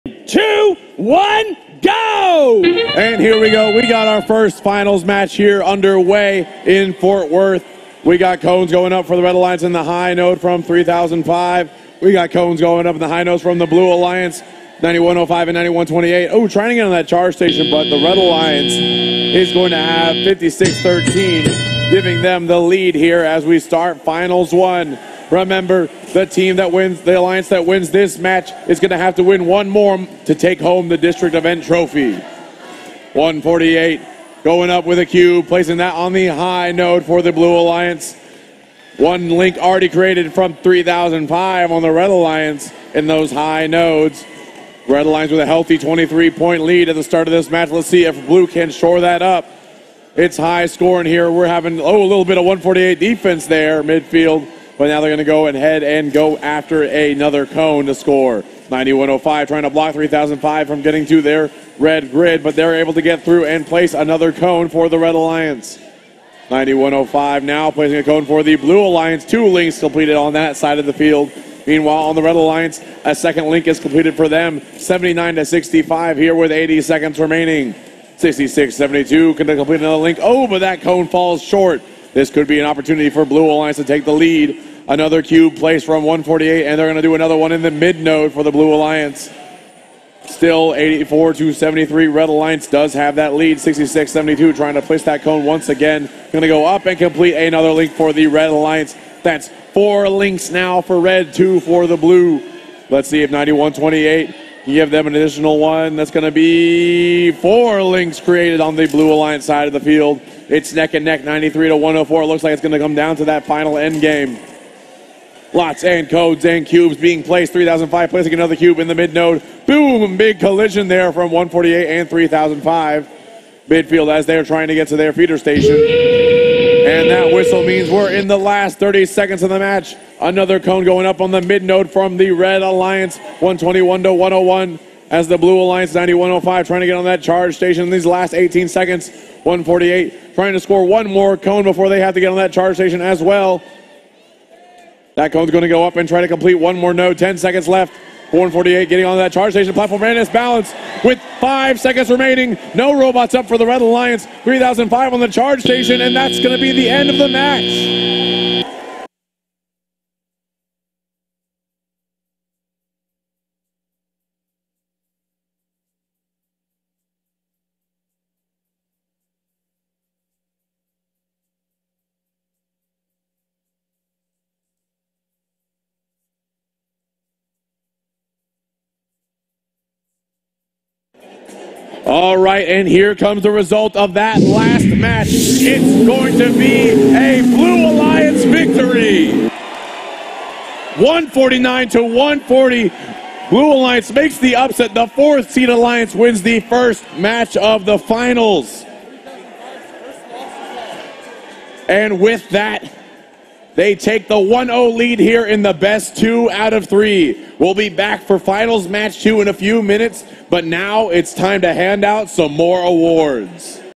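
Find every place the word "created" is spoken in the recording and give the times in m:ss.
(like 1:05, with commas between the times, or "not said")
0:39, 1:48.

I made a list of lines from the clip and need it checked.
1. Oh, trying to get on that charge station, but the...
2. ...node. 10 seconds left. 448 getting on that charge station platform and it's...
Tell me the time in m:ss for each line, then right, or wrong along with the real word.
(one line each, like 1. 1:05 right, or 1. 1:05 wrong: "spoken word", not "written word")
1. 0:16 right
2. 2:26 right.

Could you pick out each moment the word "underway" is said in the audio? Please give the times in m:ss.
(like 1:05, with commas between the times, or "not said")
0:05.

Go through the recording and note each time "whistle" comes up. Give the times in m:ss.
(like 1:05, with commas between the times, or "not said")
2:07.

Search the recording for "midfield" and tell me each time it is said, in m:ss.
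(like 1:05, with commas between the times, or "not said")
0:53, 2:03.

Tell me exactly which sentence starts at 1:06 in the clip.
9105 now placing a cone for the Blue Alliance.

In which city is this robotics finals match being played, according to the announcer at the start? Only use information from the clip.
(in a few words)
Fort Worth.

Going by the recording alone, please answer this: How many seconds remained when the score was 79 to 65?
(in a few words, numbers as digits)
80.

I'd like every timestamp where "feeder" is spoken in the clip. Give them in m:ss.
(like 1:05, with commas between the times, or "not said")
2:05.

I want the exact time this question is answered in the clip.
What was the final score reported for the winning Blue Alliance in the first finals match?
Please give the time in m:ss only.
3:11.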